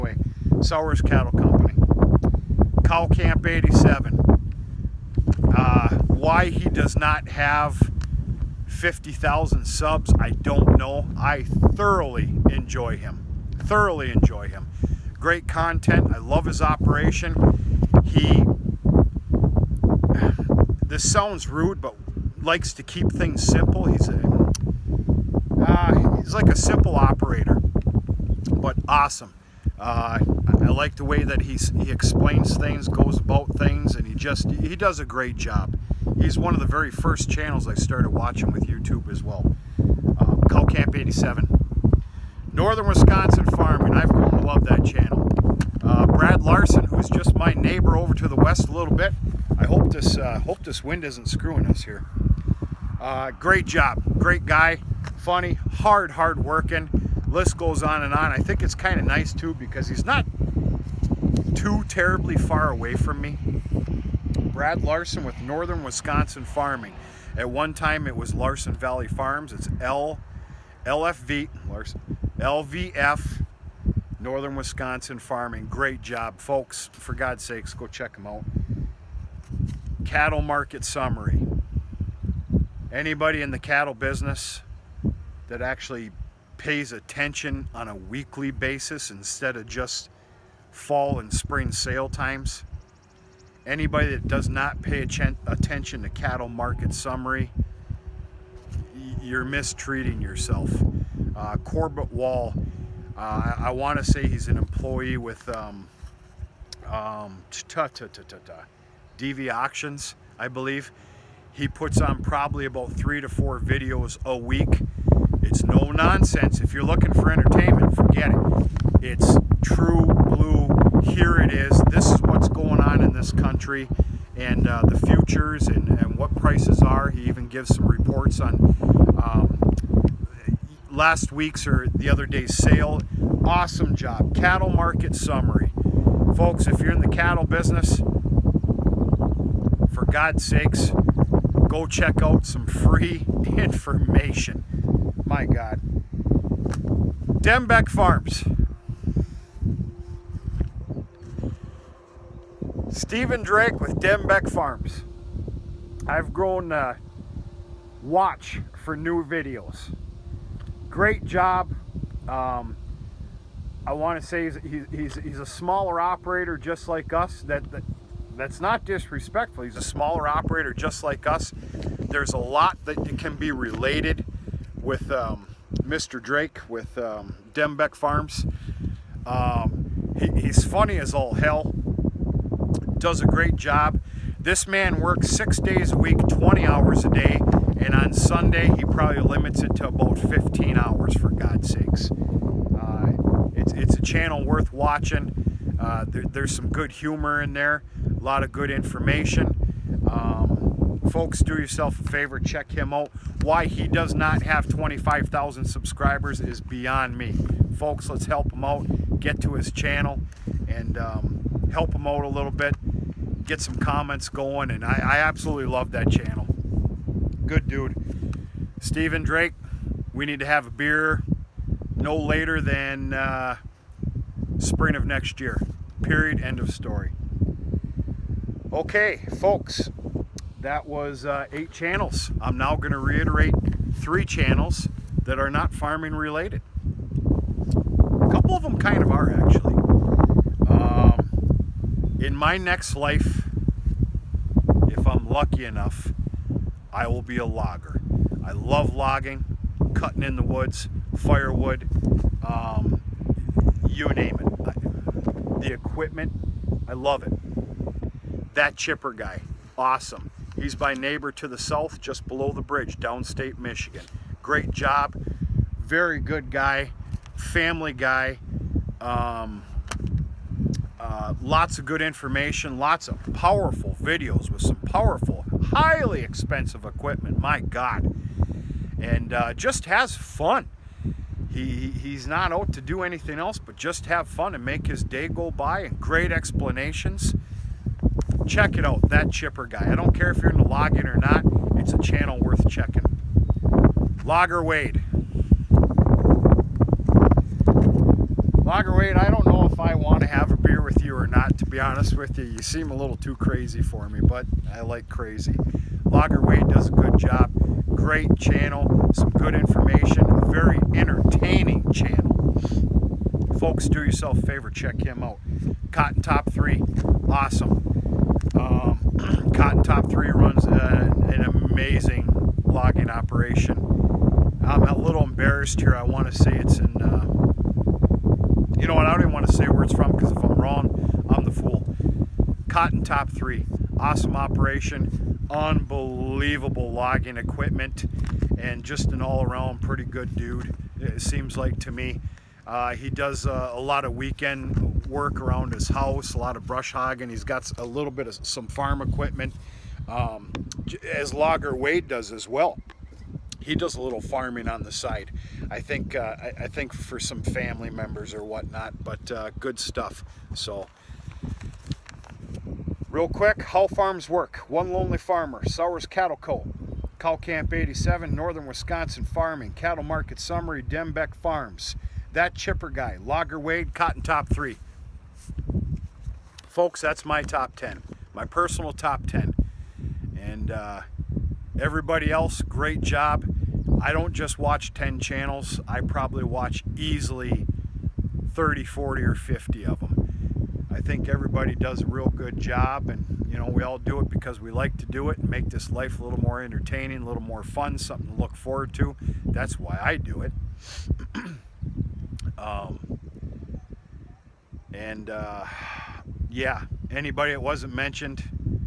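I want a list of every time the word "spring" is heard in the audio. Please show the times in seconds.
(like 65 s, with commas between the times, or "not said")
91 s, 224 s.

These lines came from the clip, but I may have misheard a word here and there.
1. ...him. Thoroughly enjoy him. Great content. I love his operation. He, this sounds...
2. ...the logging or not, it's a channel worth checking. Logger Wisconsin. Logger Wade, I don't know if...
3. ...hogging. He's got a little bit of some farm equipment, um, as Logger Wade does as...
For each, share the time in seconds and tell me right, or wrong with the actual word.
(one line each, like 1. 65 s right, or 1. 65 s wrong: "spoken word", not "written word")
1. 12 s right
2. 290 s wrong: "Wade", not "Wisconsin"
3. 346 s right.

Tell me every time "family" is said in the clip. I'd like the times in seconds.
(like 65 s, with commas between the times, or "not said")
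267 s, 357 s.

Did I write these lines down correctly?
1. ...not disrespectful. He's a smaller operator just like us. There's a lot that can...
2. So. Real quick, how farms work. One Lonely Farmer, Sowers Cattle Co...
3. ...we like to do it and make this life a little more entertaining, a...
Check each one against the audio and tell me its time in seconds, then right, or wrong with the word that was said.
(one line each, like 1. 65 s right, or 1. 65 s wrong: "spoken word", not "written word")
1. 168 s right
2. 360 s right
3. 394 s right.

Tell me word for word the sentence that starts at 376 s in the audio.
Folks, that's my top 10, my personal top 10.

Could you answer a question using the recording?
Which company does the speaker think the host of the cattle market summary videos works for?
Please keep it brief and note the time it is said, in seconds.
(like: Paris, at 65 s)
DV Auctions, at 109 s.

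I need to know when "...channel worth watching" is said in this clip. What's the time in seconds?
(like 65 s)
194 s.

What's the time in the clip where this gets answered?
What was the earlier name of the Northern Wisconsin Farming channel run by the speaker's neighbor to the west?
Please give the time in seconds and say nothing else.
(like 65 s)
68 s.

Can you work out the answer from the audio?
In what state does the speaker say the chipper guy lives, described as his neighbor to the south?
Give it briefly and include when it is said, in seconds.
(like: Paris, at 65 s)
Michigan, at 263 s.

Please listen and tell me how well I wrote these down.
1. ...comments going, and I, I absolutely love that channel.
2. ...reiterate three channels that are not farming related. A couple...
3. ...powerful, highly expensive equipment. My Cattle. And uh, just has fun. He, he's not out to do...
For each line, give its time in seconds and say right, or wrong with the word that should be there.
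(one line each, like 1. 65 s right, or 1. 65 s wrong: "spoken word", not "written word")
1. 213 s right
2. 232 s right
3. 274 s wrong: "God", not "Cattle".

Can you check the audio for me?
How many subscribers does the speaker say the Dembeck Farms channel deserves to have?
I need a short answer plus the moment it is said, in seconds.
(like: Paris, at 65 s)
25,000, at 204 s.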